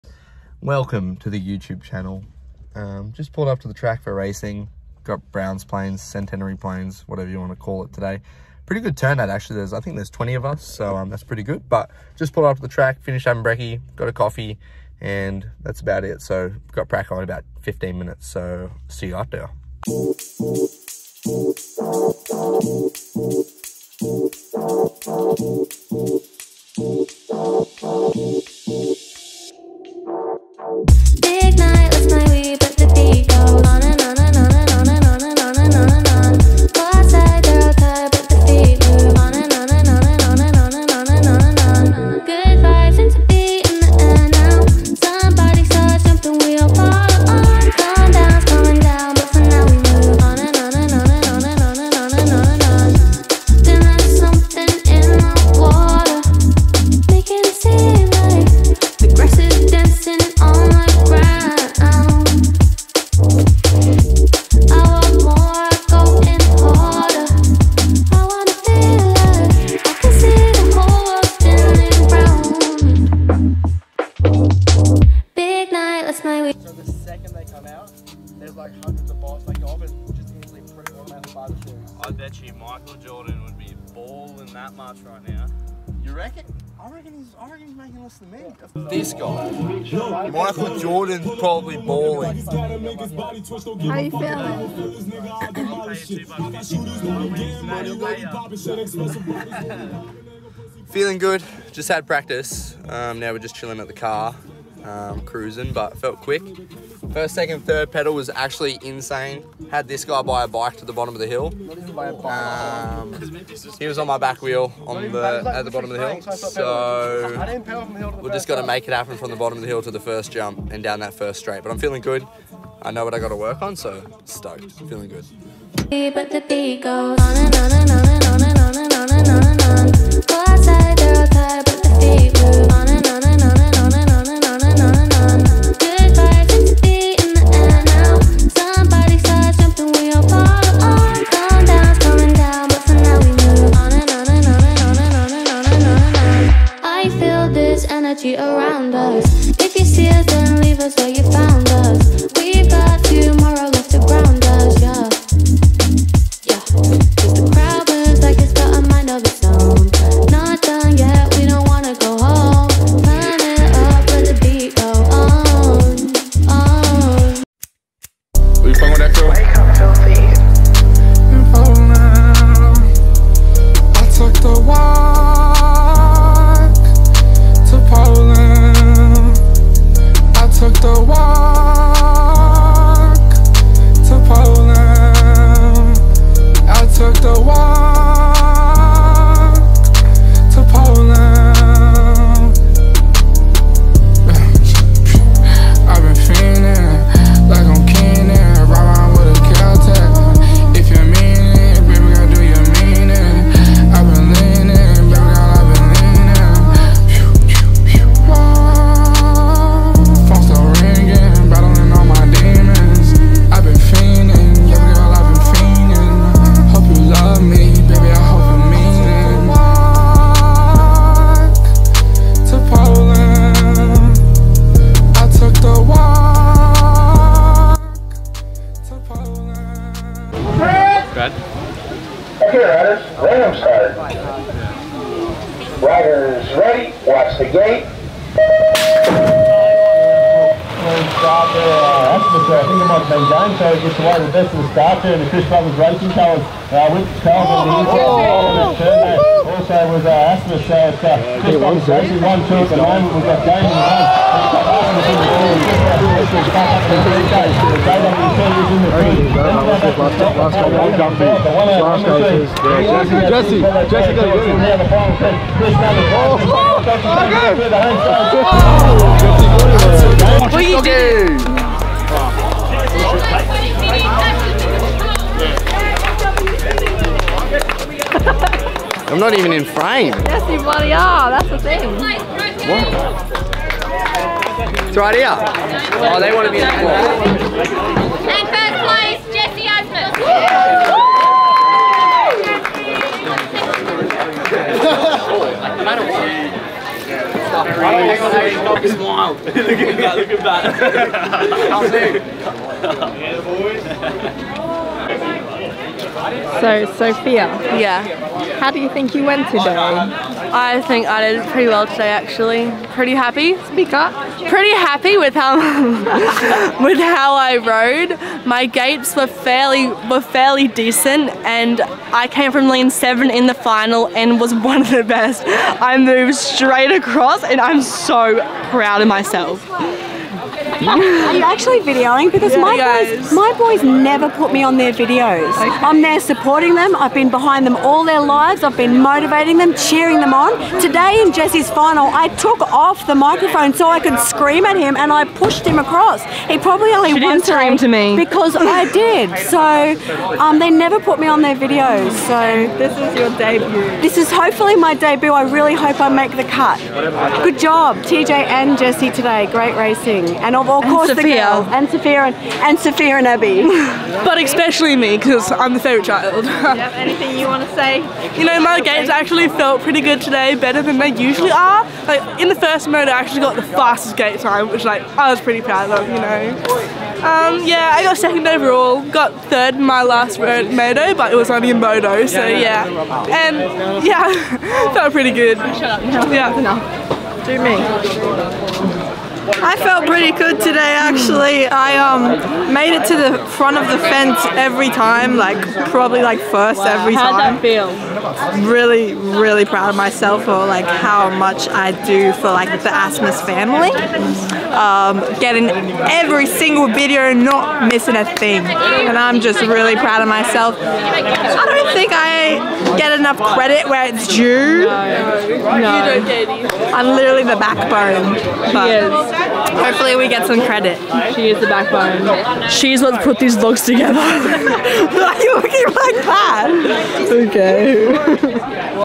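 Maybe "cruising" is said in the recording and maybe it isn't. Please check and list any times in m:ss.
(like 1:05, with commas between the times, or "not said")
1:45.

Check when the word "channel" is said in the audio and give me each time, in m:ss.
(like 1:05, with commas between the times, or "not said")
0:01.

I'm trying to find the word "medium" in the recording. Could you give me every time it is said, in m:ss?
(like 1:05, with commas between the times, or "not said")
not said.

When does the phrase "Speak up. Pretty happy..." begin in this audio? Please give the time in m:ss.
5:13.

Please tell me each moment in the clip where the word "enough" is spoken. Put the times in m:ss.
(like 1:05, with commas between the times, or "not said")
6:26, 6:53.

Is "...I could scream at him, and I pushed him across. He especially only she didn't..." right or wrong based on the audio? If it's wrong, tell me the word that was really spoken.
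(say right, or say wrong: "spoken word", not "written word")
wrong: "probably", not "especially".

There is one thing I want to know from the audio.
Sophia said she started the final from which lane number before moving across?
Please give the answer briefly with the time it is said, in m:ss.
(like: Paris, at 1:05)
7, at 5:22.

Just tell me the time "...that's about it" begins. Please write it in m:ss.
0:15.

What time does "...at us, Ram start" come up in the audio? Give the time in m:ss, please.
3:52.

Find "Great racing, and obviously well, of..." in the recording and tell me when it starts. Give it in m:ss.
5:59.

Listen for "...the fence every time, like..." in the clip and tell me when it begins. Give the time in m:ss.
6:33.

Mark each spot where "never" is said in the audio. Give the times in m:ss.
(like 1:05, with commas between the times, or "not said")
5:33, 5:50.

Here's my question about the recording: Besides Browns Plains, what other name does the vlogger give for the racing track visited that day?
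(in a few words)
Centenary Plains.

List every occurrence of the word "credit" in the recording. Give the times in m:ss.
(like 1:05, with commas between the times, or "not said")
6:53, 7:00.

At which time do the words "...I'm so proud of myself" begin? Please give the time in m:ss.
5:27.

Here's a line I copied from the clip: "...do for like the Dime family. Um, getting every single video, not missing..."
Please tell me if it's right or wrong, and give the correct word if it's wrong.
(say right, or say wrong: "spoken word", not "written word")
wrong: "Asmus", not "Dime".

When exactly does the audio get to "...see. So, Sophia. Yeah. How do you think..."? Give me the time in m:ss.
5:06.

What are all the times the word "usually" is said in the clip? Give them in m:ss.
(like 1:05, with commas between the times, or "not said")
6:11.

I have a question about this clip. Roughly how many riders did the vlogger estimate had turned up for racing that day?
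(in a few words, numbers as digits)
20.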